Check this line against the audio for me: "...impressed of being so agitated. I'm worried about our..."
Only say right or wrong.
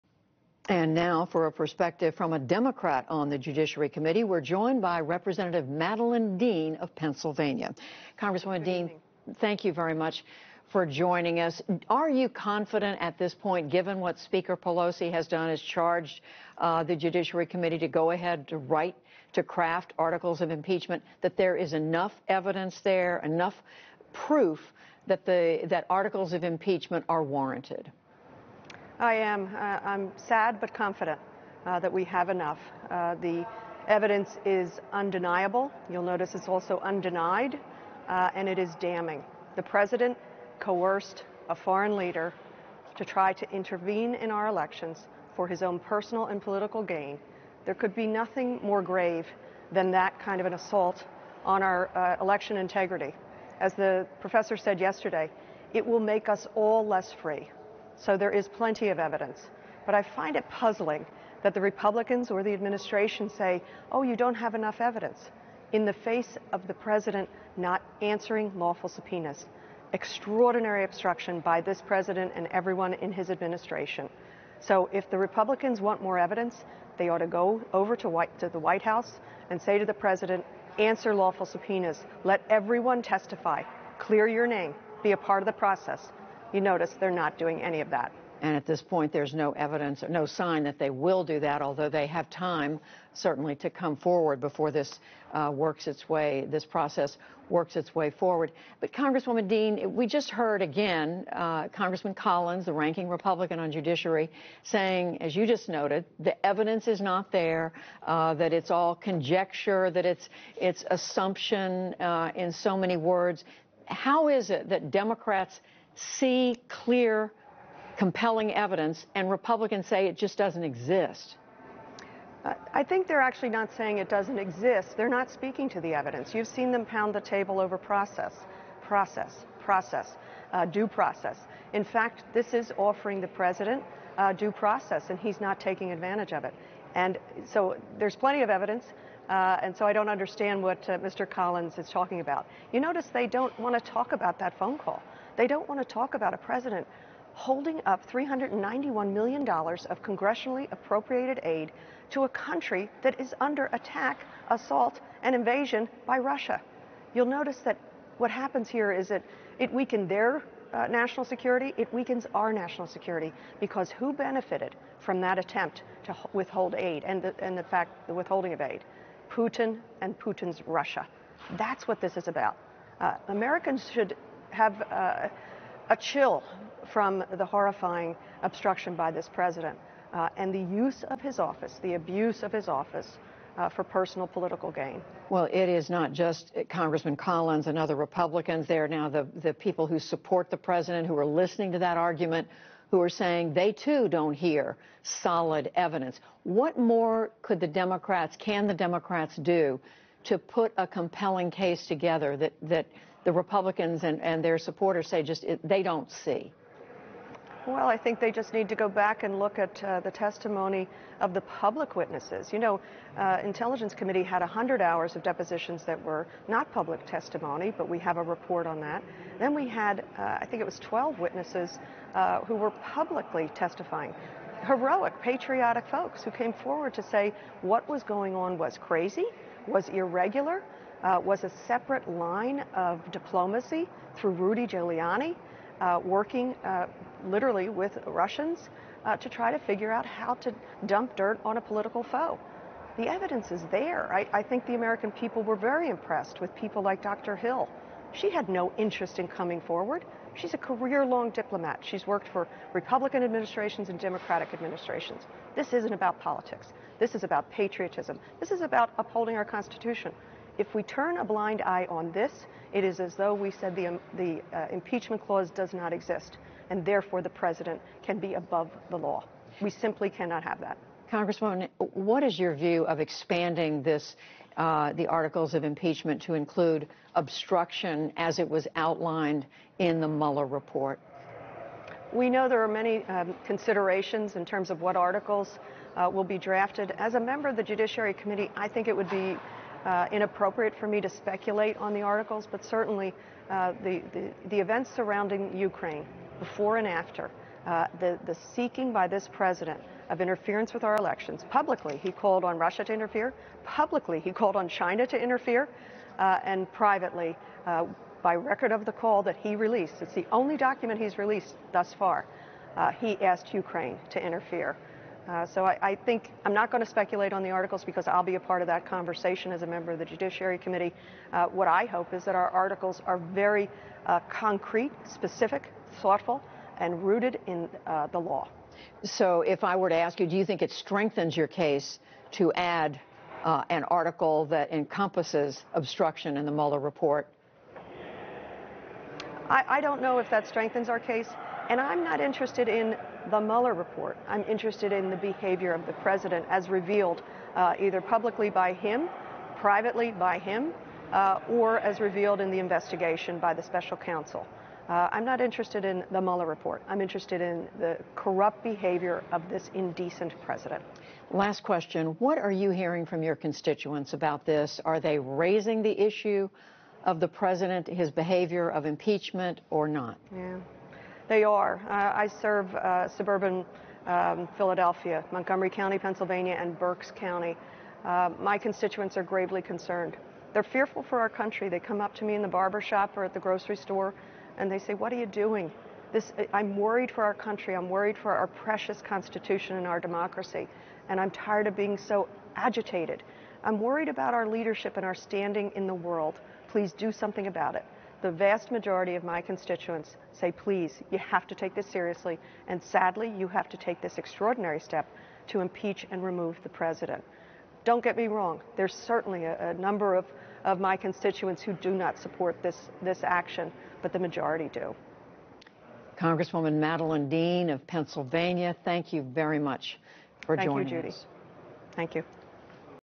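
wrong.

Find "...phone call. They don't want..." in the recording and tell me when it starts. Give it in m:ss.
2:24.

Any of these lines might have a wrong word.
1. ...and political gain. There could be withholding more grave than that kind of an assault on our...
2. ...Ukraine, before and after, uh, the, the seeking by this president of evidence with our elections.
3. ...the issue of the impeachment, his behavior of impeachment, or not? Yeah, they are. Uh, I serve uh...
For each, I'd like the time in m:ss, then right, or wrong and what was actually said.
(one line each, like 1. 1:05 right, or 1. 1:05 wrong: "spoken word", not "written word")
1. 0:46 wrong: "nothing", not "withholding"
2. 4:55 wrong: "interference", not "evidence"
3. 6:05 wrong: "president", not "impeachment".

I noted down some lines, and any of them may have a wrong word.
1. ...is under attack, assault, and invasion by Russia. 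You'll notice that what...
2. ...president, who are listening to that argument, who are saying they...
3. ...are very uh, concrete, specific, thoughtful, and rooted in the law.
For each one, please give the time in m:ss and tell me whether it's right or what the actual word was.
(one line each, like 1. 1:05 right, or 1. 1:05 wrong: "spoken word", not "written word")
1. 2:33 right
2. 3:10 right
3. 5:23 right.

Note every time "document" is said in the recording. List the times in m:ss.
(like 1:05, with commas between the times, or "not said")
5:10.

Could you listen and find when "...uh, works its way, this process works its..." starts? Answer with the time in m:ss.
1:35.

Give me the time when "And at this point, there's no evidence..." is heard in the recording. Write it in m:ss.
1:28.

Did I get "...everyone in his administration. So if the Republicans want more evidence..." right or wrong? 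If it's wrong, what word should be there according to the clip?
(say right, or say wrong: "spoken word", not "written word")
right.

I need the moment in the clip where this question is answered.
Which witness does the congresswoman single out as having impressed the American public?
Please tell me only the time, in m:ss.
4:07.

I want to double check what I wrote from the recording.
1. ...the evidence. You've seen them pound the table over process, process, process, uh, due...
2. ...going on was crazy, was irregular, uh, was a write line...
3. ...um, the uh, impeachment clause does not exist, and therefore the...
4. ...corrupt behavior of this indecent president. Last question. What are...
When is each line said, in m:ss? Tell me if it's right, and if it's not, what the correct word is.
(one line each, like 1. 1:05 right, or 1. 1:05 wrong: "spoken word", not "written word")
1. 2:05 right
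2. 3:48 wrong: "separate", not "write"
3. 4:23 right
4. 5:58 right.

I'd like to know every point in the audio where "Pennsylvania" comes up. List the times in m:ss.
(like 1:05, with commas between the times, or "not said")
0:06, 6:15, 6:57.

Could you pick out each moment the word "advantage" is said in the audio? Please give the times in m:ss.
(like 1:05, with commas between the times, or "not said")
2:15.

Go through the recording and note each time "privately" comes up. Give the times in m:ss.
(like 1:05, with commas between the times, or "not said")
5:06, 5:49.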